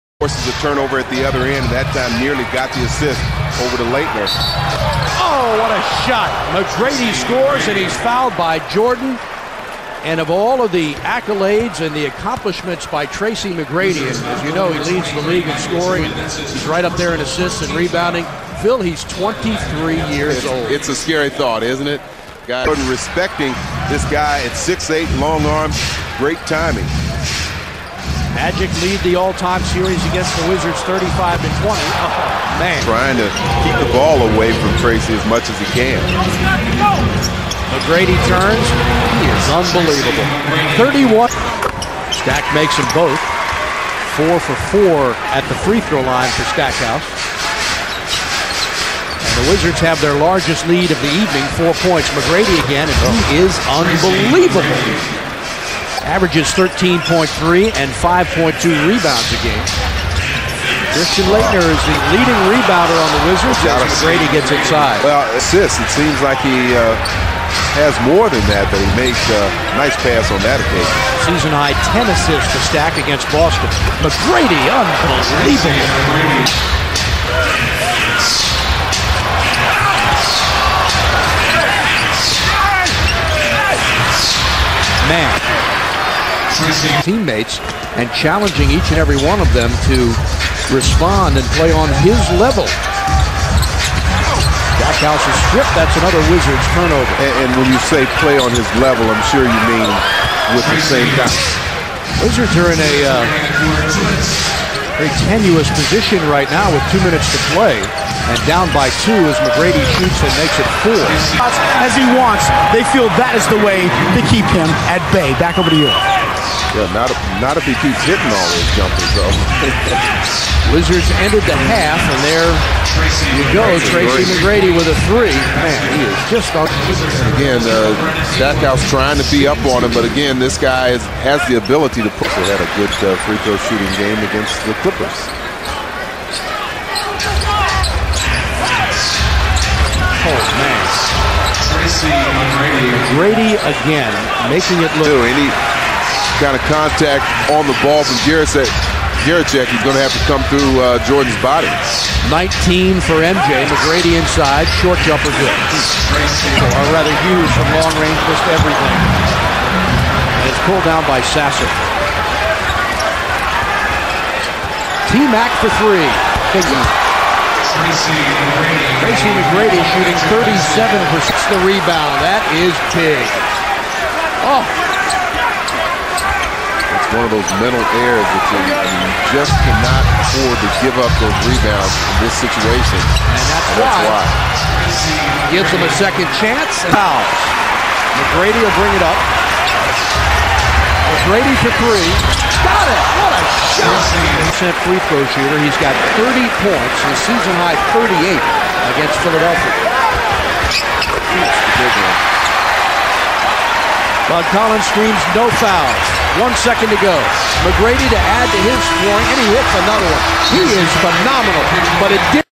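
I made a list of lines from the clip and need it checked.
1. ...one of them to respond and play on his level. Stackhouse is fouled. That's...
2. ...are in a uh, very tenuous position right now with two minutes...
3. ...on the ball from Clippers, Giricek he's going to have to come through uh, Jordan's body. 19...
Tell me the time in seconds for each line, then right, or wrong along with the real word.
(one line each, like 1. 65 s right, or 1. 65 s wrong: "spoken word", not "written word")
1. 89 s wrong: "stripped", not "fouled"
2. 102 s right
3. 147 s wrong: "Giricek", not "Clippers".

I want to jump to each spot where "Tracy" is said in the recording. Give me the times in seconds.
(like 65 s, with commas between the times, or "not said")
13 s, 34 s, 123 s, 141 s, 167 s.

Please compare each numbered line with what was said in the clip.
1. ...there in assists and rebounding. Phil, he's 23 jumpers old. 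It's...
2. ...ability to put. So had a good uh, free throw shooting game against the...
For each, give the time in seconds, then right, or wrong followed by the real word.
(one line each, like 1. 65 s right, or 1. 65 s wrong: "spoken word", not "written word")
1. 16 s wrong: "years", not "jumpers"
2. 131 s right.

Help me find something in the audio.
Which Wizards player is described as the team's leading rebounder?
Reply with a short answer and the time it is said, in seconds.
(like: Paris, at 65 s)
Christian Laettner, at 60 s.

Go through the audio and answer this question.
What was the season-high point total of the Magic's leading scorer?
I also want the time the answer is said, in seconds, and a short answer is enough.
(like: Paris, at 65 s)
38, at 197 s.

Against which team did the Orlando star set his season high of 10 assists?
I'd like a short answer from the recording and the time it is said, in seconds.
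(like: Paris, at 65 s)
Boston, at 73 s.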